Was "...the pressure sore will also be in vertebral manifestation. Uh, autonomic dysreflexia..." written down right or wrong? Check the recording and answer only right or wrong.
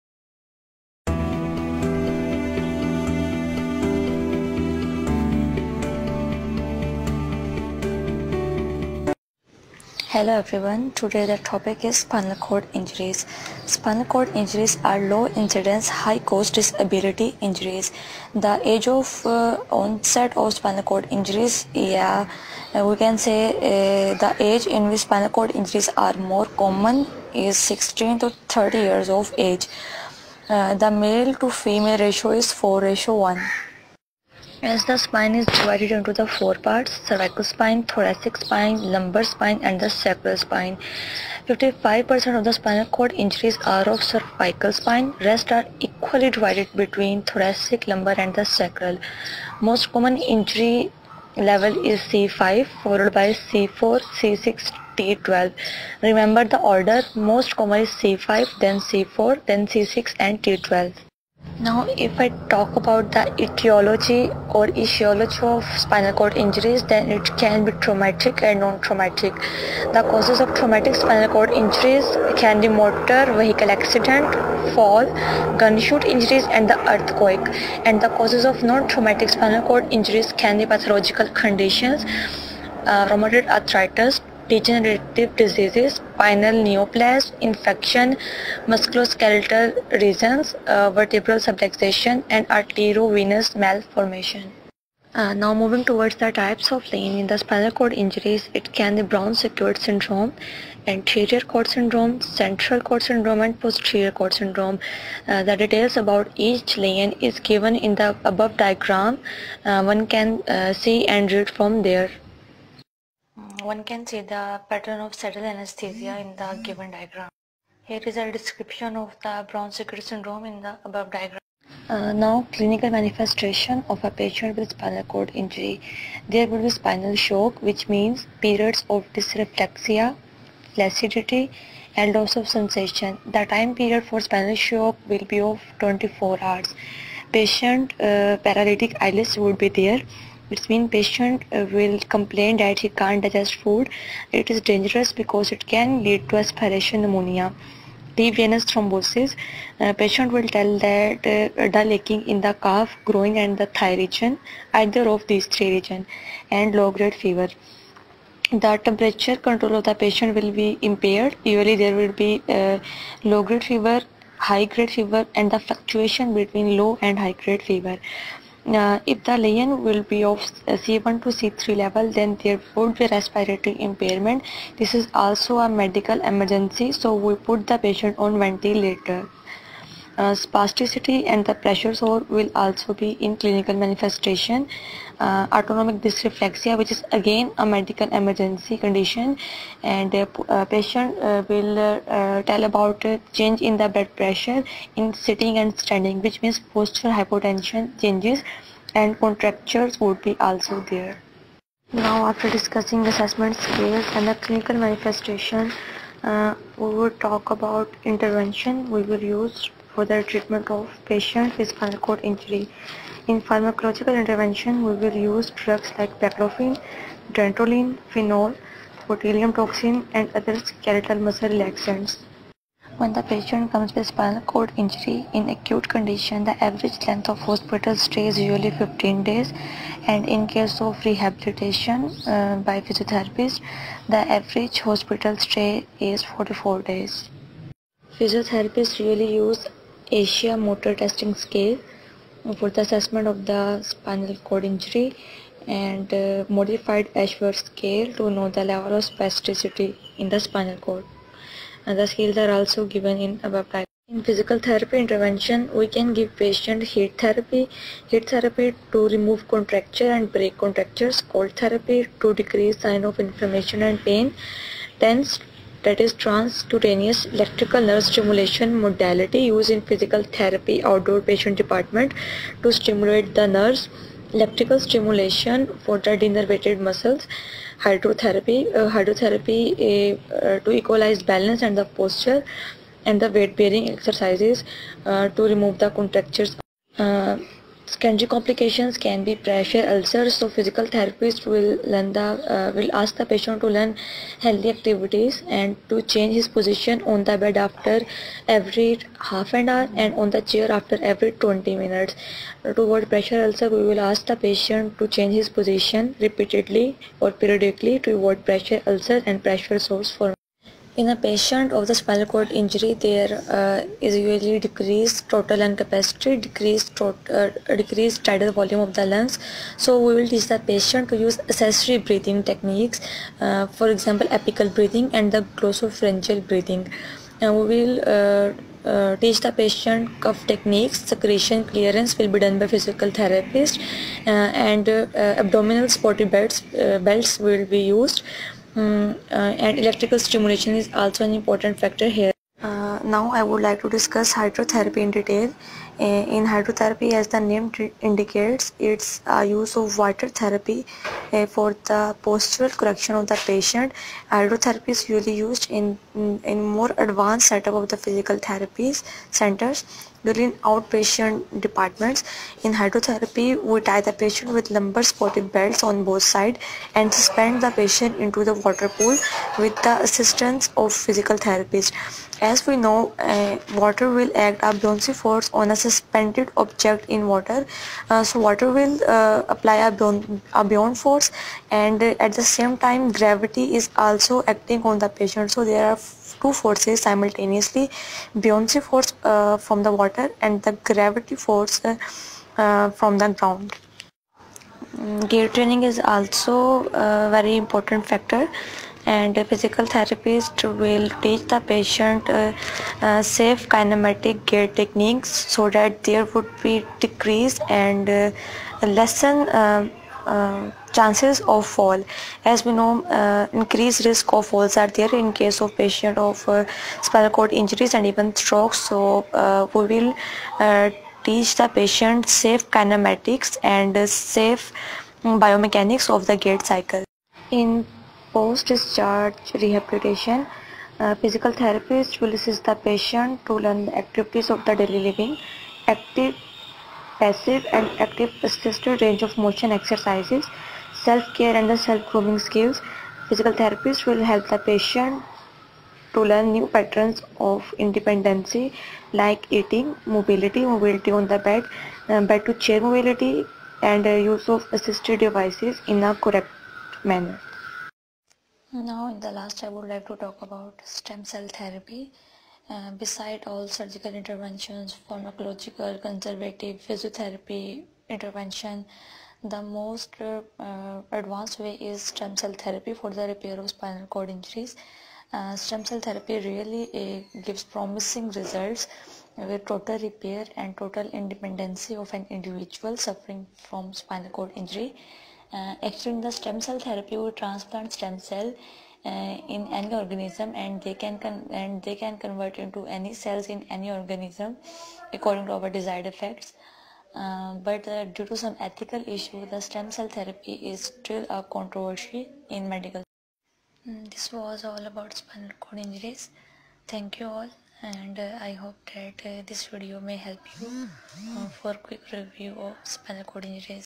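wrong.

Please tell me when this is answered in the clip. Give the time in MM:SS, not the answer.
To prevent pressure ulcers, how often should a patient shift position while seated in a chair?
05:01.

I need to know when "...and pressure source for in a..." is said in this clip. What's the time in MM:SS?
05:09.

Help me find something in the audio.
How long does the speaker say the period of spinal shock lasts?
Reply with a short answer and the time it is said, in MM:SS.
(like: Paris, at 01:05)
24 hours, at 02:15.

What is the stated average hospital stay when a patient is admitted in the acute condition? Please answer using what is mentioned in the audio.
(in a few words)
15 days.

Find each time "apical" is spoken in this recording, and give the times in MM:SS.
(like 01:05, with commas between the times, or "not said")
05:24.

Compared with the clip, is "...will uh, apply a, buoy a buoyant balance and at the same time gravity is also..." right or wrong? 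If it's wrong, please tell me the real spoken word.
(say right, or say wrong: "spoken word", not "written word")
wrong: "force", not "balance".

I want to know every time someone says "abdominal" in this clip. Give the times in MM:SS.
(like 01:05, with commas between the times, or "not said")
05:35.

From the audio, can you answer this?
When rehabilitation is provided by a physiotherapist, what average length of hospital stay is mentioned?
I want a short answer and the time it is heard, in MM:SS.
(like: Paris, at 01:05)
44 days, at 03:56.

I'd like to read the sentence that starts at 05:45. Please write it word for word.
In hydrotherapy as the name indicates, it's a use of water therapy for the postural correction of the patient.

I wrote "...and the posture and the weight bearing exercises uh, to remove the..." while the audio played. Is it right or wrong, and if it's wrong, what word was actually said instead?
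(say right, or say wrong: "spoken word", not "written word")
right.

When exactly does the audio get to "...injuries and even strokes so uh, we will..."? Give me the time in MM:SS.
06:57.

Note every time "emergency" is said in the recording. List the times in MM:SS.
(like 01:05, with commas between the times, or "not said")
02:56, 03:08.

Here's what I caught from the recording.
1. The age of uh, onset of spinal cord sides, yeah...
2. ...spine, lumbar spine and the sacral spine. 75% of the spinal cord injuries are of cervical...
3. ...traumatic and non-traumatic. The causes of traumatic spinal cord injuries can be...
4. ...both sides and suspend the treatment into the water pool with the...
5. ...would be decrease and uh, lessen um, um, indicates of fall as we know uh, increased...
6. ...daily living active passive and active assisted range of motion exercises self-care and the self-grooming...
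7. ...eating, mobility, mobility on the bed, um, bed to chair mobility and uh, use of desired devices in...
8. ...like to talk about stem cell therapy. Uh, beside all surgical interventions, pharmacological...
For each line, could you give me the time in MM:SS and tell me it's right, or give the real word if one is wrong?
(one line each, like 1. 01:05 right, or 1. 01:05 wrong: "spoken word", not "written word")
1. 00:18 wrong: "injuries", not "sides"
2. 00:38 wrong: "55", not "75"
3. 01:07 right
4. 06:06 wrong: "patient", not "treatment"
5. 06:46 wrong: "chances", not "indicates"
6. 07:14 right
7. 07:29 wrong: "assisted", not "desired"
8. 07:39 right.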